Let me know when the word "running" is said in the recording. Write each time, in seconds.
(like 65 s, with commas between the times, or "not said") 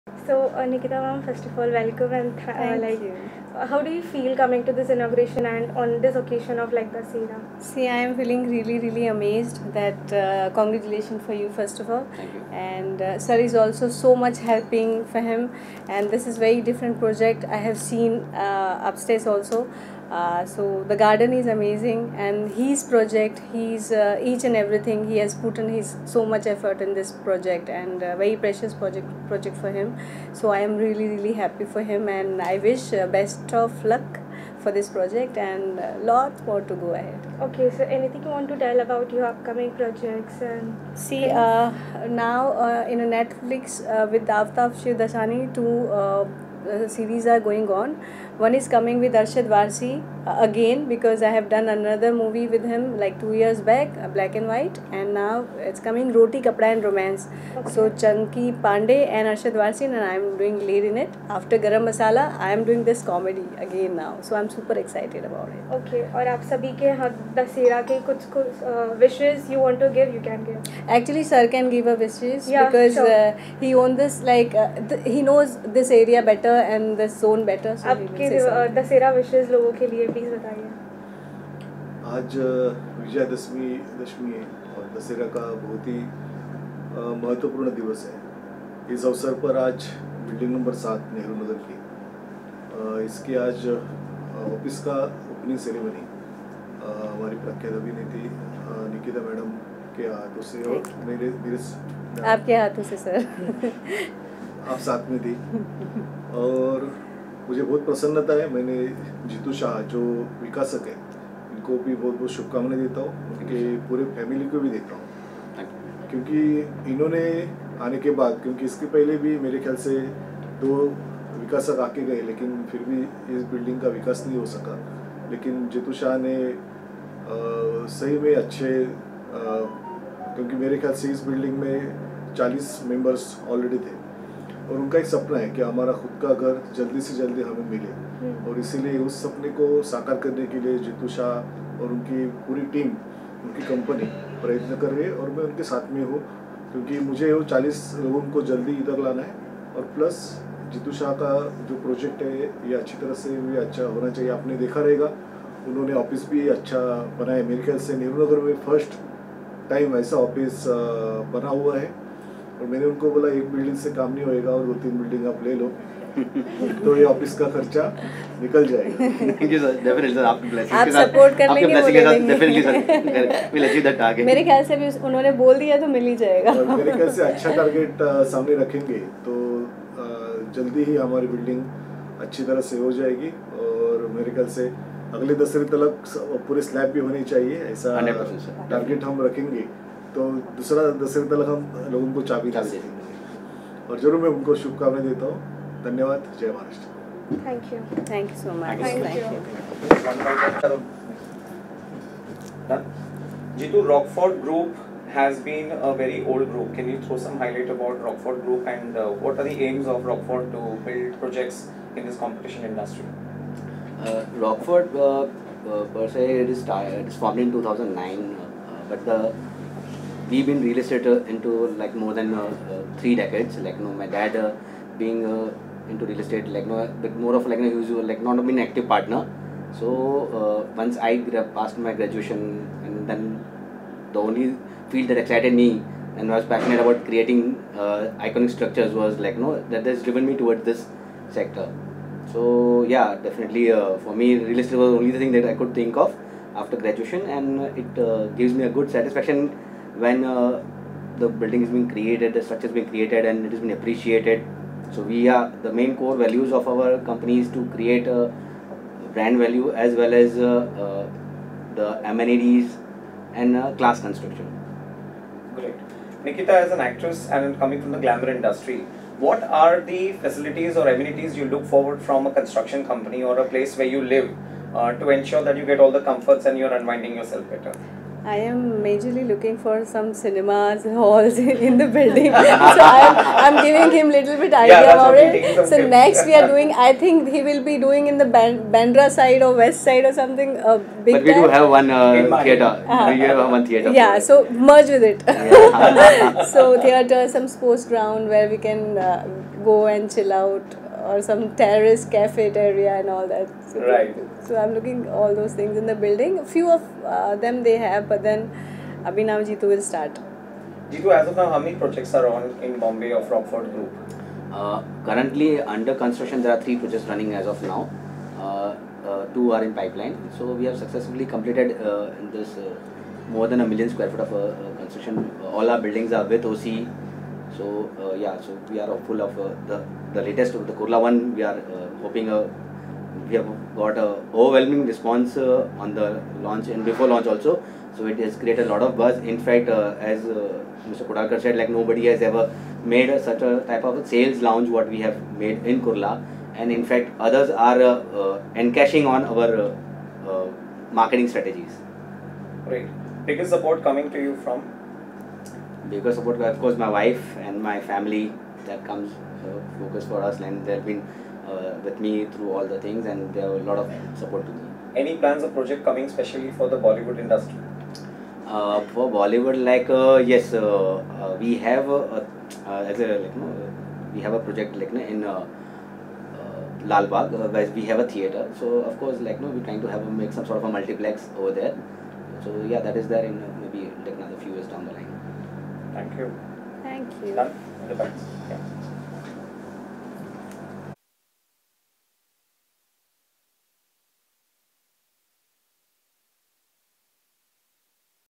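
317 s.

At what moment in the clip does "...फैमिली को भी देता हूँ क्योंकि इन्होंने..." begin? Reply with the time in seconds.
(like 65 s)
114 s.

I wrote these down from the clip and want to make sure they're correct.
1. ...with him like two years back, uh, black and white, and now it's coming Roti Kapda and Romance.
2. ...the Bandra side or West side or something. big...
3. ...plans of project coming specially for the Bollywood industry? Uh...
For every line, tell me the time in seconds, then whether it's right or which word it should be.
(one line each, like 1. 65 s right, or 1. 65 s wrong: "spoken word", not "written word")
1. 52 s right
2. 288 s right
3. 365 s right.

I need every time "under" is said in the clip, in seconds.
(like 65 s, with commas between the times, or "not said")
315 s.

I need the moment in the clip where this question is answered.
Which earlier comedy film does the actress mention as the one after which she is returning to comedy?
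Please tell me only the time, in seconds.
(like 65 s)
61 s.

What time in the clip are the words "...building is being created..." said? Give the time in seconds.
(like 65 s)
251 s.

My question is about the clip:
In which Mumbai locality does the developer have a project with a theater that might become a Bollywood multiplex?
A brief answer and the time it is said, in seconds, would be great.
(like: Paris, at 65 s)
Lal Bagh, at 376 s.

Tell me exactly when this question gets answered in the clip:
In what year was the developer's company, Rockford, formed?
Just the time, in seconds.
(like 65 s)
217 s.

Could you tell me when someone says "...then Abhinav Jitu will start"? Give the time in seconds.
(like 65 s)
308 s.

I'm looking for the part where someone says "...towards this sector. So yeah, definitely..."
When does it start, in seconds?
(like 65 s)
240 s.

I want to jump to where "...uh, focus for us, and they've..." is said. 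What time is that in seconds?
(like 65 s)
359 s.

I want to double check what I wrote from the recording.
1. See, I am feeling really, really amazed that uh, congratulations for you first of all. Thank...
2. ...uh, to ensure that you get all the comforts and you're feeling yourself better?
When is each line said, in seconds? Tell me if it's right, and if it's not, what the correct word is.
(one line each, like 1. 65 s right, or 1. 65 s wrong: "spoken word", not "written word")
1. 7 s right
2. 274 s wrong: "unwinding", not "feeling".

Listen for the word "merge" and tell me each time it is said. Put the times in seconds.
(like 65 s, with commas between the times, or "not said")
294 s.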